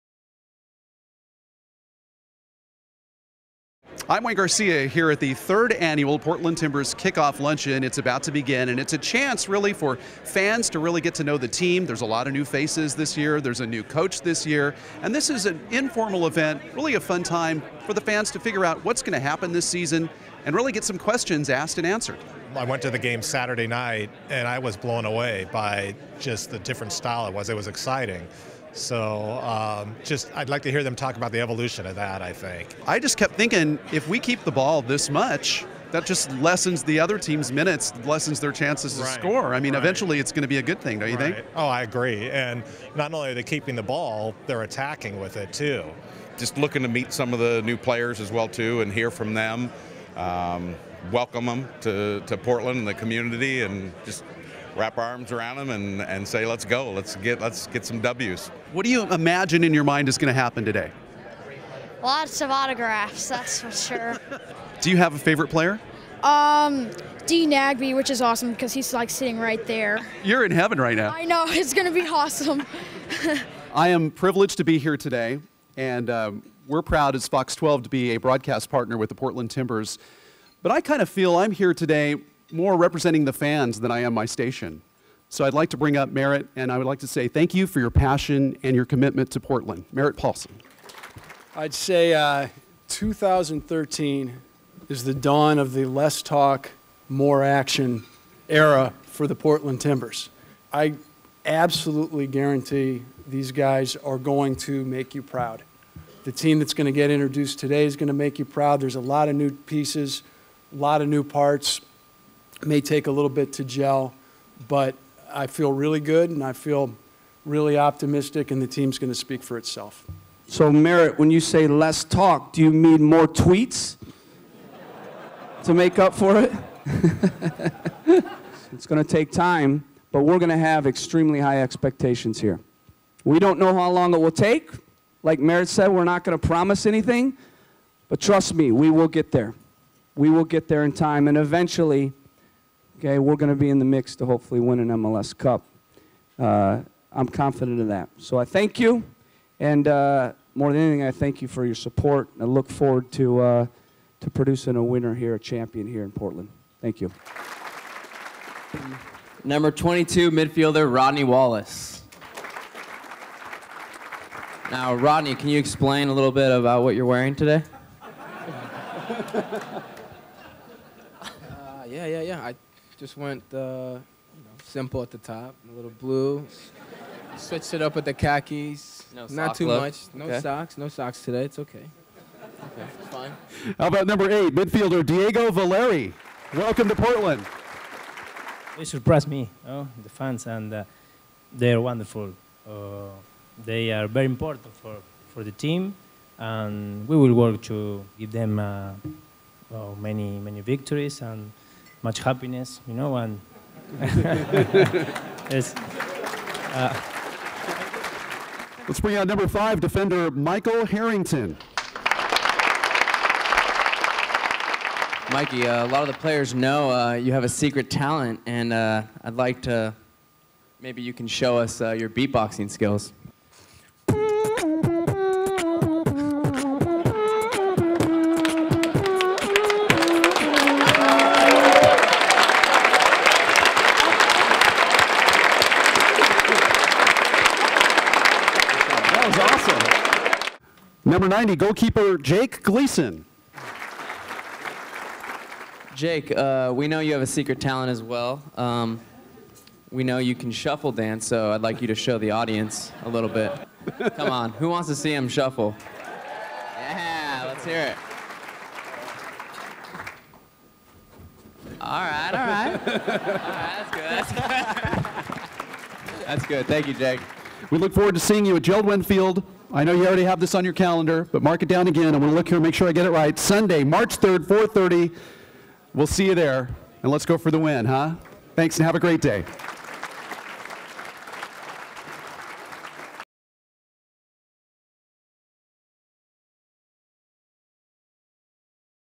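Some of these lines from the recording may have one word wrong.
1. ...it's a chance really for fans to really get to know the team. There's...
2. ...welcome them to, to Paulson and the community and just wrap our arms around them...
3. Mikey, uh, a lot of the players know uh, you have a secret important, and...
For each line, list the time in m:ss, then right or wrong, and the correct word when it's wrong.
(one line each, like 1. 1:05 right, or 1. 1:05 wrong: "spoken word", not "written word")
1. 0:08 right
2. 0:51 wrong: "Portland", not "Paulson"
3. 3:35 wrong: "talent", not "important".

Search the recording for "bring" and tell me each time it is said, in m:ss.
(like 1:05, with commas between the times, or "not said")
1:25, 3:29.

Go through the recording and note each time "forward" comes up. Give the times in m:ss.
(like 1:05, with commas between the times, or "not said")
2:32, 4:27.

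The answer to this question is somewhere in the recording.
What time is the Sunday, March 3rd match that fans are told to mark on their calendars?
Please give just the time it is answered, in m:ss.
4:34.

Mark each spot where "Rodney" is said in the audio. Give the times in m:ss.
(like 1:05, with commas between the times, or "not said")
2:40, 2:44.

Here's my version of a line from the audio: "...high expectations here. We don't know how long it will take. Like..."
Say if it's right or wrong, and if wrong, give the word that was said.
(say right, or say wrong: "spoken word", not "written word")
right.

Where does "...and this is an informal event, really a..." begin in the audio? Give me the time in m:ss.
0:15.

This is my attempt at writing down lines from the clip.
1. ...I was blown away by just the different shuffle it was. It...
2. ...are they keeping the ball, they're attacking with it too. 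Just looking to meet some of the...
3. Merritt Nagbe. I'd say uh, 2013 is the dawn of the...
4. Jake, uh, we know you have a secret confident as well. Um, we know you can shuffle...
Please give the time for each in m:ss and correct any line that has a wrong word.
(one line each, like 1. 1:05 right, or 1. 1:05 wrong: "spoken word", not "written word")
1. 0:24 wrong: "style", not "shuffle"
2. 0:43 right
3. 1:29 wrong: "Paulson", not "Nagbe"
4. 4:05 wrong: "talent", not "confident".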